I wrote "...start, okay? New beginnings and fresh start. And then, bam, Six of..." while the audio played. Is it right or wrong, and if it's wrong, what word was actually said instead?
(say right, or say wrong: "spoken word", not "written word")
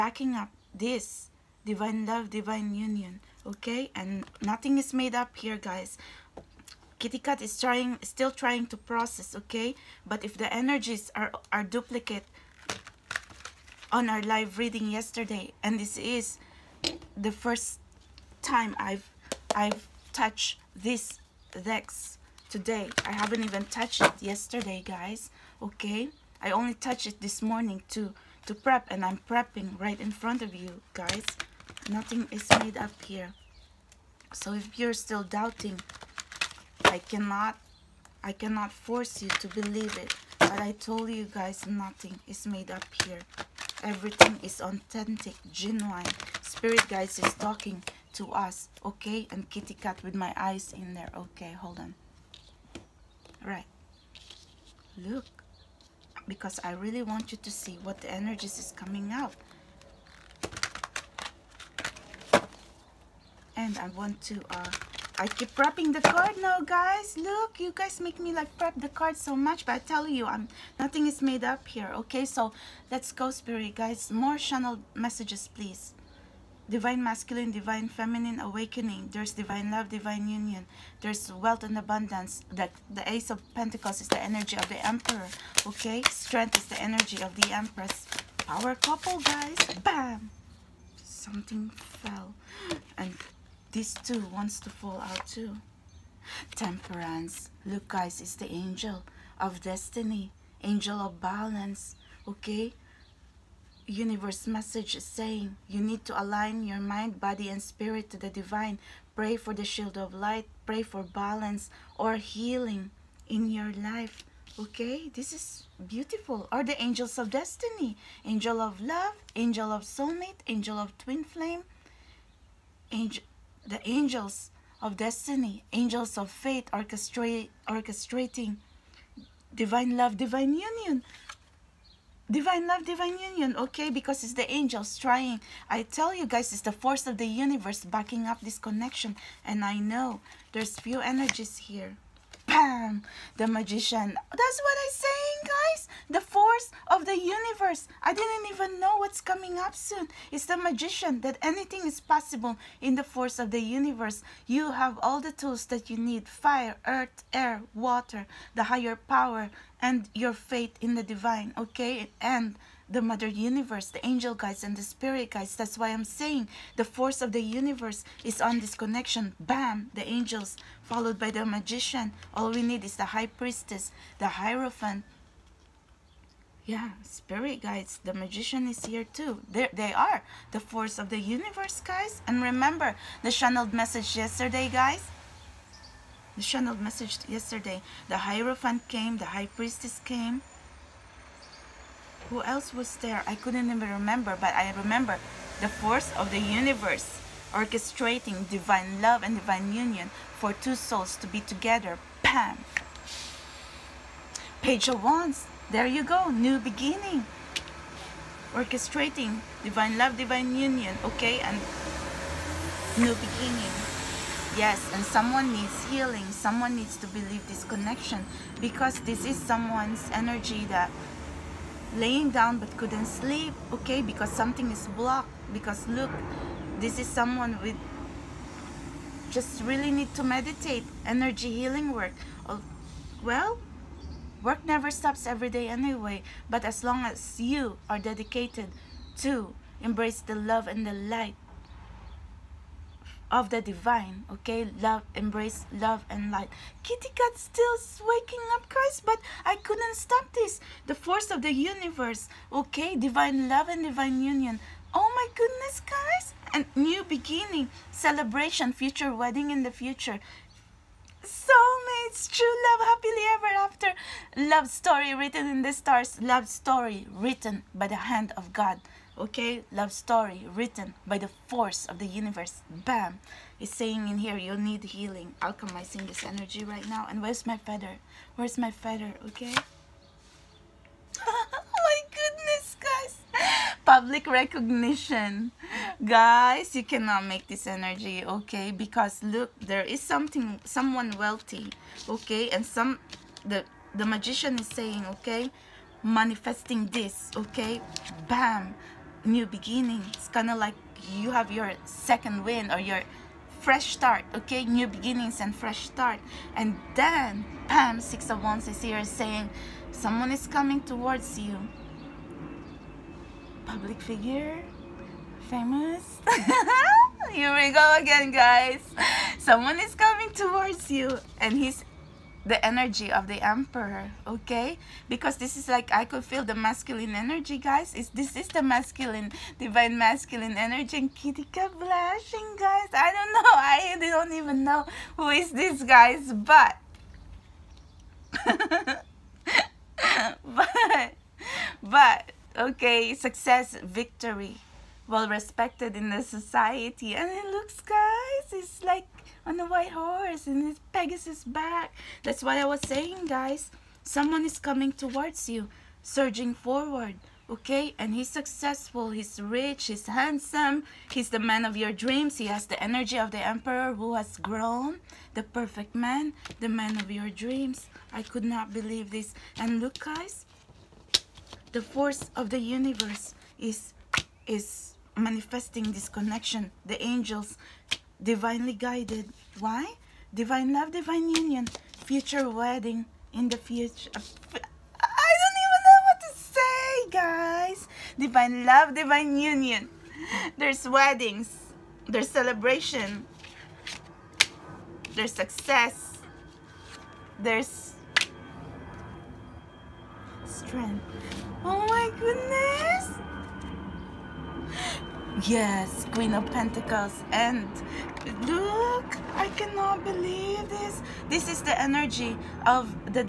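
right.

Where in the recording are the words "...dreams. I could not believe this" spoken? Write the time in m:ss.
6:07.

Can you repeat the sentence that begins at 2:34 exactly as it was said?
You have all the tools that you need.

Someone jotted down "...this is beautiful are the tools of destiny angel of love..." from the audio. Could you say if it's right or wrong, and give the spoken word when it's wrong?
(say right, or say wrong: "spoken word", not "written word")
wrong: "angels", not "tools".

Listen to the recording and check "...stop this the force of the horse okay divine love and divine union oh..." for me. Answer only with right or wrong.
wrong.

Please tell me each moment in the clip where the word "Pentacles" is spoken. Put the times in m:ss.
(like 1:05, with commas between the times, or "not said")
1:23, 6:46.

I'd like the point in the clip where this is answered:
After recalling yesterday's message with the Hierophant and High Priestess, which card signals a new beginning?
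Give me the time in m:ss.
3:24.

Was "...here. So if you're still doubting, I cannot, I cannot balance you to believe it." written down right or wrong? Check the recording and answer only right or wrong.
wrong.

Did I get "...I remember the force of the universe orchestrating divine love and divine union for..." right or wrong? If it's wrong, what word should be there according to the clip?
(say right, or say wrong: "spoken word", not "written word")
right.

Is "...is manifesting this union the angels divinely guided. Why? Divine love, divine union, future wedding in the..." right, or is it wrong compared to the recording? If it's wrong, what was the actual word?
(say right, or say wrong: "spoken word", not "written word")
wrong: "connection", not "union".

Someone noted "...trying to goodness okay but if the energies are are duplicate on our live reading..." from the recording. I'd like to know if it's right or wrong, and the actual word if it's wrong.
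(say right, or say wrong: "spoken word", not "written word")
wrong: "process", not "goodness".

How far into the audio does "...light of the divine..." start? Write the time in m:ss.
4:00.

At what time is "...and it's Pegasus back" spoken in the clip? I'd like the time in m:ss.
5:50.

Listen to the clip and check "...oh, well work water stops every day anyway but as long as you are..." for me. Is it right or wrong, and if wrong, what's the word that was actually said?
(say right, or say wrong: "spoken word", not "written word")
wrong: "never", not "water".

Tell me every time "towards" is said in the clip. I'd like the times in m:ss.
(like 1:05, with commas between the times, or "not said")
5:10, 5:20, 5:54.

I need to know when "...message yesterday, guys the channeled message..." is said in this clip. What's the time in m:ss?
3:03.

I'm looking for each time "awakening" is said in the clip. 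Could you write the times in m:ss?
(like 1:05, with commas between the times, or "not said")
1:18.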